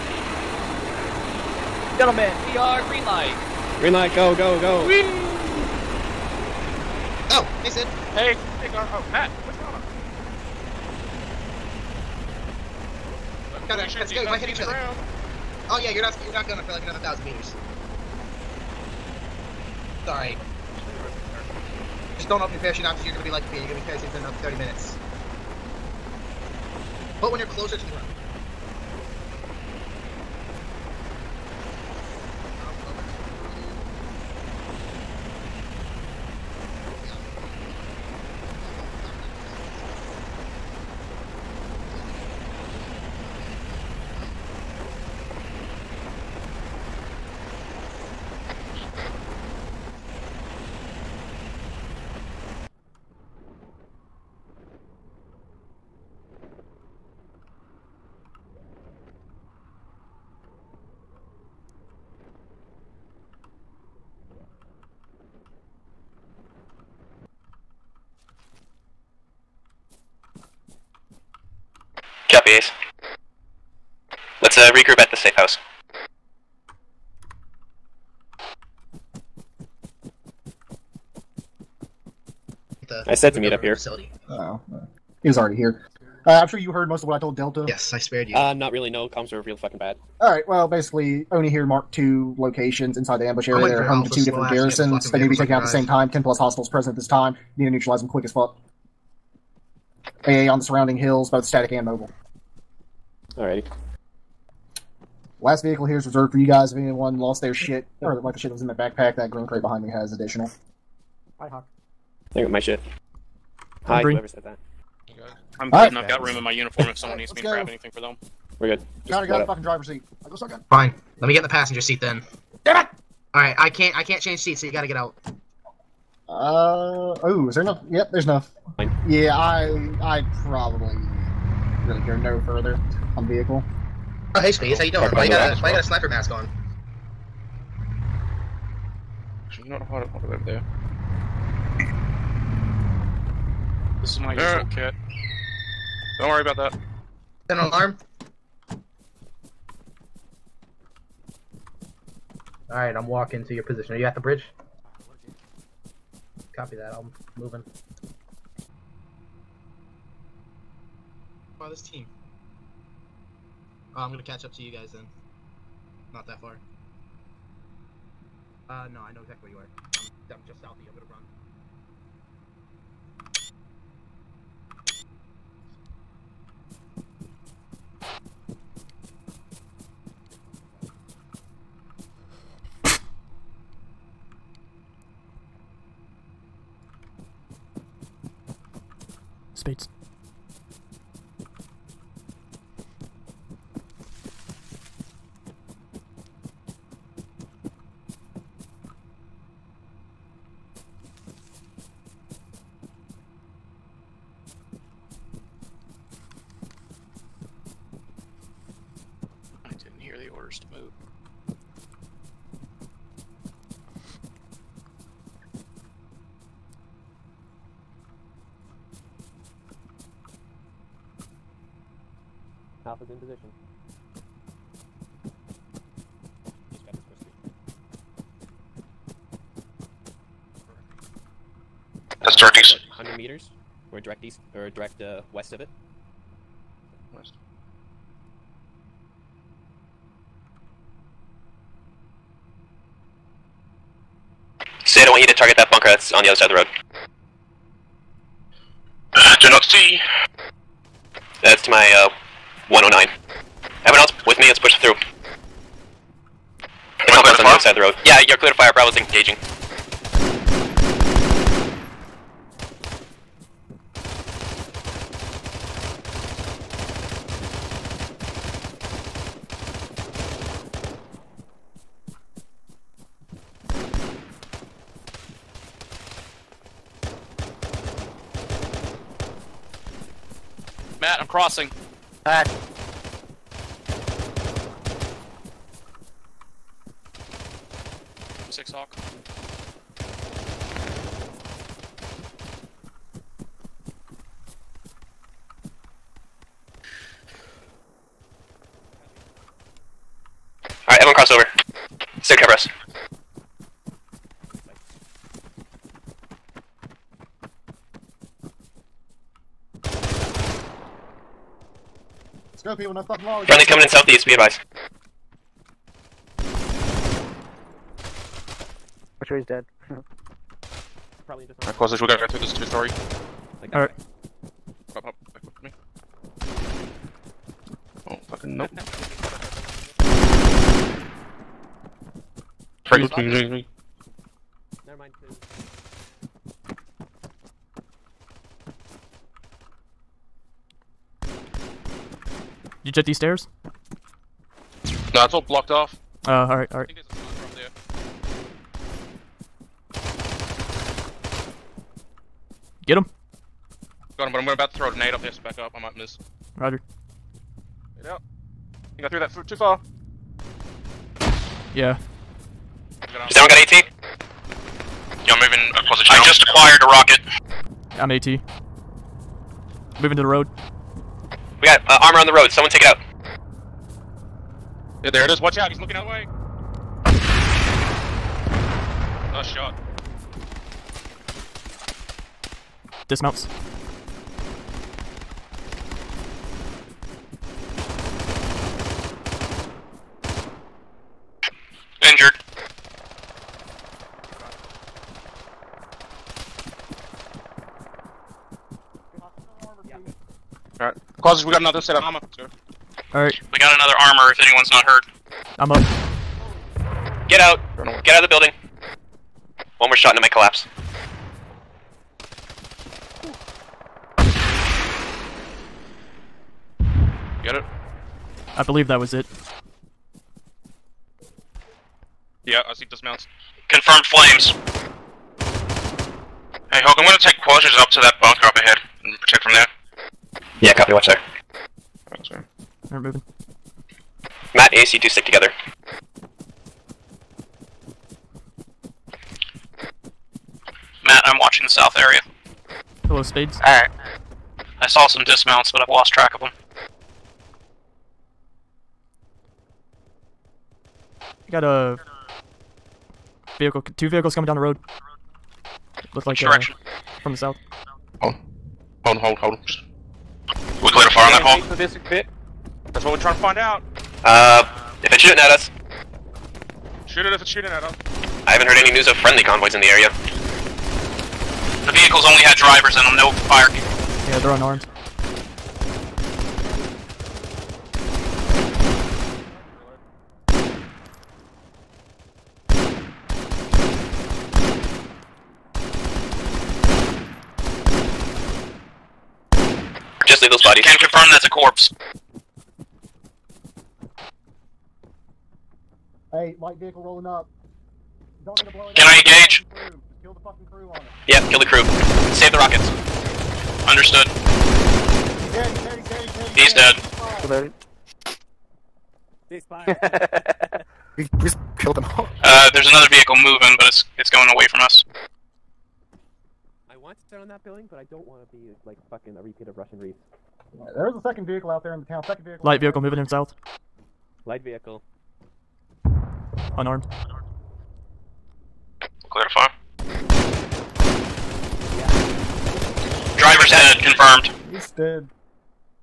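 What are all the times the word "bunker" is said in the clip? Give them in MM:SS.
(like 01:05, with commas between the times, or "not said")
04:05, 07:08.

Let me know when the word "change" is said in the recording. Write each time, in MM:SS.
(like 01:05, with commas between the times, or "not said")
02:04.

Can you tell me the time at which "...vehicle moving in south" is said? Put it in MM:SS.
08:42.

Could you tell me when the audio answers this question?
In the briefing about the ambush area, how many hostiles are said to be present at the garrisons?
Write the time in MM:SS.
01:36.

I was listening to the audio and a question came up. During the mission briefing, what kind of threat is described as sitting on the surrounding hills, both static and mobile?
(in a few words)
AA.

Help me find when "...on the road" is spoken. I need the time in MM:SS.
06:12.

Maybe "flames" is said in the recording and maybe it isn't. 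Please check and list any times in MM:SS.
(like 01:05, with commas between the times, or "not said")
07:04.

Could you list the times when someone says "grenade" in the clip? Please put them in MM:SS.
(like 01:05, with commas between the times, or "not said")
05:54.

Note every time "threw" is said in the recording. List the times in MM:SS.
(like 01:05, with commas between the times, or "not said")
05:59.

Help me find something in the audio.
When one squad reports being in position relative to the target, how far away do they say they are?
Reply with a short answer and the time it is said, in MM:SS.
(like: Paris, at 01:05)
100 meters, at 03:52.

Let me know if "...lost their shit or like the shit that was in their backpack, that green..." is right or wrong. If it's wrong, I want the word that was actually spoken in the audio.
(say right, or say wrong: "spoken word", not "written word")
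right.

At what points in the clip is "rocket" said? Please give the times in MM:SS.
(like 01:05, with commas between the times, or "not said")
06:06, 08:22.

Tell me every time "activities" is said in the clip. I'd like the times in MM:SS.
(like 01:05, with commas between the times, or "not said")
not said.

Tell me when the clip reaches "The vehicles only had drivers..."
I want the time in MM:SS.
07:51.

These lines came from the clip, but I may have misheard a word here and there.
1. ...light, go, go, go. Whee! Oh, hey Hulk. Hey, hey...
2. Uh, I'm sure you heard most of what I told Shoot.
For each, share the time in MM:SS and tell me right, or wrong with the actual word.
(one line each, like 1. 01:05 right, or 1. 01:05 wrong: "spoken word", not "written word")
1. 00:03 wrong: "Sid", not "Hulk"
2. 01:26 wrong: "Delta", not "Shoot".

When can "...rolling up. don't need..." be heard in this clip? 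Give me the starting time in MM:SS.
08:17.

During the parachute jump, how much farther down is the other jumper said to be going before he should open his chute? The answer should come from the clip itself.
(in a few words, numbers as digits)
1000 meters.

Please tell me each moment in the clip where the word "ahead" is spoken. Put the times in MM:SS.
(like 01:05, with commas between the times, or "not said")
07:08.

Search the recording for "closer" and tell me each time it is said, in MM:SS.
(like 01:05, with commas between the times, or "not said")
00:27.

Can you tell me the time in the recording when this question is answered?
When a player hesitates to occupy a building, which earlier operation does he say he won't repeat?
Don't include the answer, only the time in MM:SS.
08:39.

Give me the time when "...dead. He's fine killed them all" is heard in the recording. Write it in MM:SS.
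08:30.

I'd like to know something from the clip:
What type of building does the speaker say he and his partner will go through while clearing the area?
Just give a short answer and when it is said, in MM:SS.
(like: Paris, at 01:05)
Two story, at 05:22.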